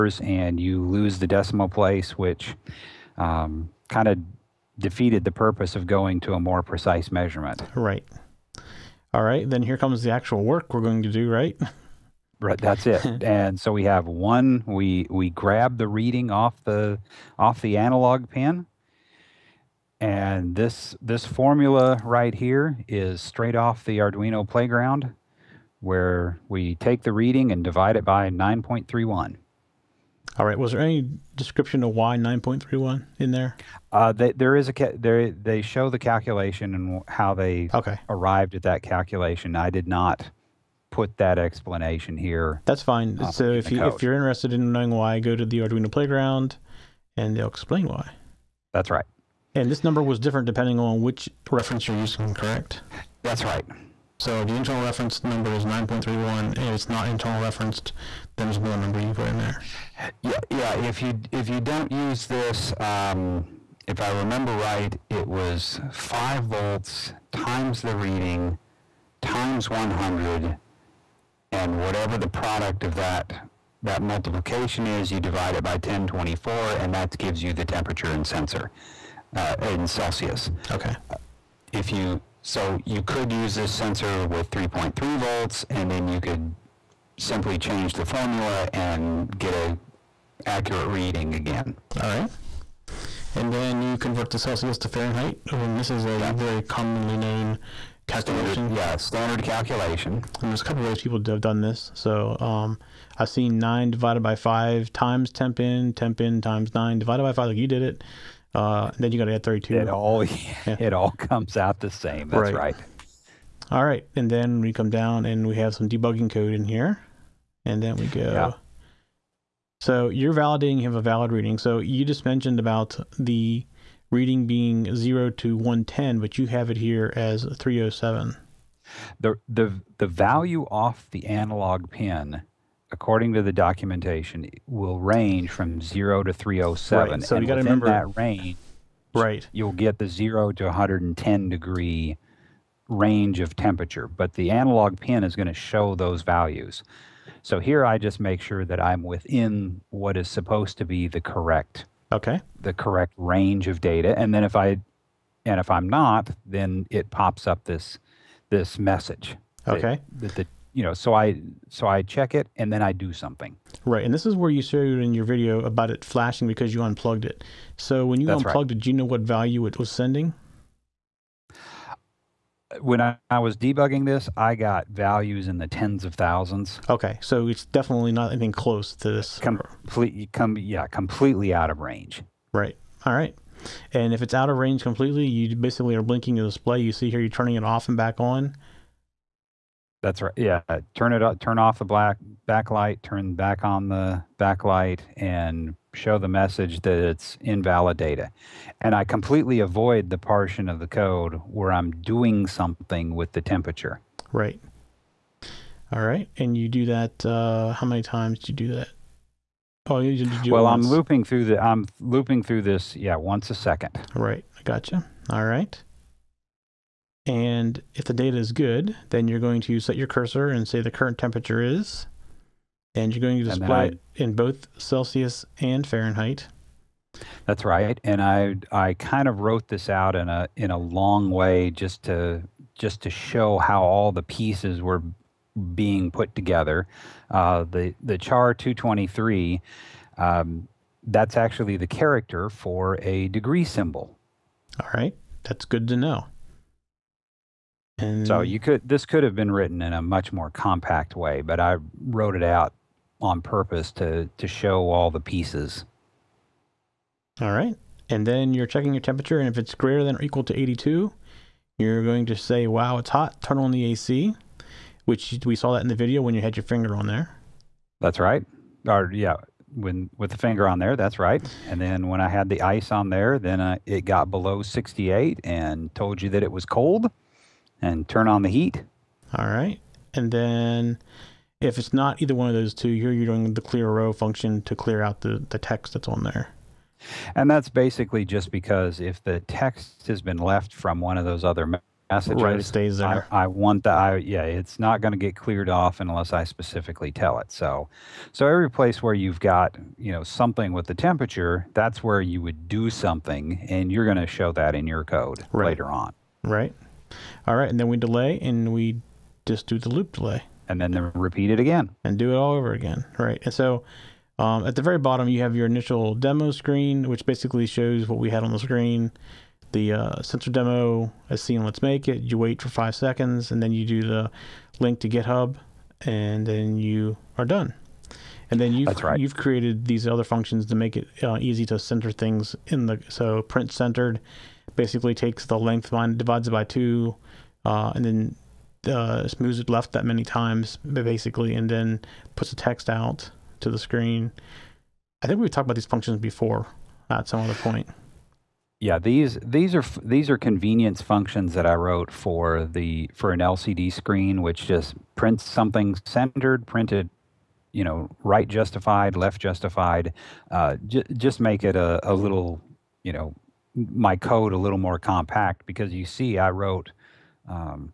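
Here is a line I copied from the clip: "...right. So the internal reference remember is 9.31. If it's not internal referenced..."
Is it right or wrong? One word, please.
wrong.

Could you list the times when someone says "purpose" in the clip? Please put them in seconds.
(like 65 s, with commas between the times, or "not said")
5 s, 253 s.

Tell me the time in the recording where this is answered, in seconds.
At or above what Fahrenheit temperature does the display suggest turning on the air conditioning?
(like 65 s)
260 s.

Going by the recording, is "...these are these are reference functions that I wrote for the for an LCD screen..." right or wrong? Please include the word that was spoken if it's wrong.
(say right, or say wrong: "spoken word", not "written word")
wrong: "convenience", not "reference".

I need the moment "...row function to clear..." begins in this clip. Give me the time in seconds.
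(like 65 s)
283 s.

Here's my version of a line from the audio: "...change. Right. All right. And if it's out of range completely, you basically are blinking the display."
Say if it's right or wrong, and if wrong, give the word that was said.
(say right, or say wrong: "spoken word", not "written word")
wrong: "range", not "change".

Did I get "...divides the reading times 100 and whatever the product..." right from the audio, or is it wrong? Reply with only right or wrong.
wrong.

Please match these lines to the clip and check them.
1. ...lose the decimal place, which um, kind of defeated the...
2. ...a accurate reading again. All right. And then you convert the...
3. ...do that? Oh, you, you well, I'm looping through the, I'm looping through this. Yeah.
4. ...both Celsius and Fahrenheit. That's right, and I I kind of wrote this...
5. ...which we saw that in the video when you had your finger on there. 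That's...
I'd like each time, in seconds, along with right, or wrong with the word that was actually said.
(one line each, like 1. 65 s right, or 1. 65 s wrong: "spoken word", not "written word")
1. 0 s right
2. 89 s right
3. 208 s right
4. 224 s right
5. 265 s right.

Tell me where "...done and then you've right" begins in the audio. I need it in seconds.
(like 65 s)
327 s.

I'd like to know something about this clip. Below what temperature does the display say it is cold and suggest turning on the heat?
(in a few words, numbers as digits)
68.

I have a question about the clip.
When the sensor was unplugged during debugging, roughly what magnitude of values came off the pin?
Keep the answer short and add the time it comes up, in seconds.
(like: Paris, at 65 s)
tens of thousands, at 175 s.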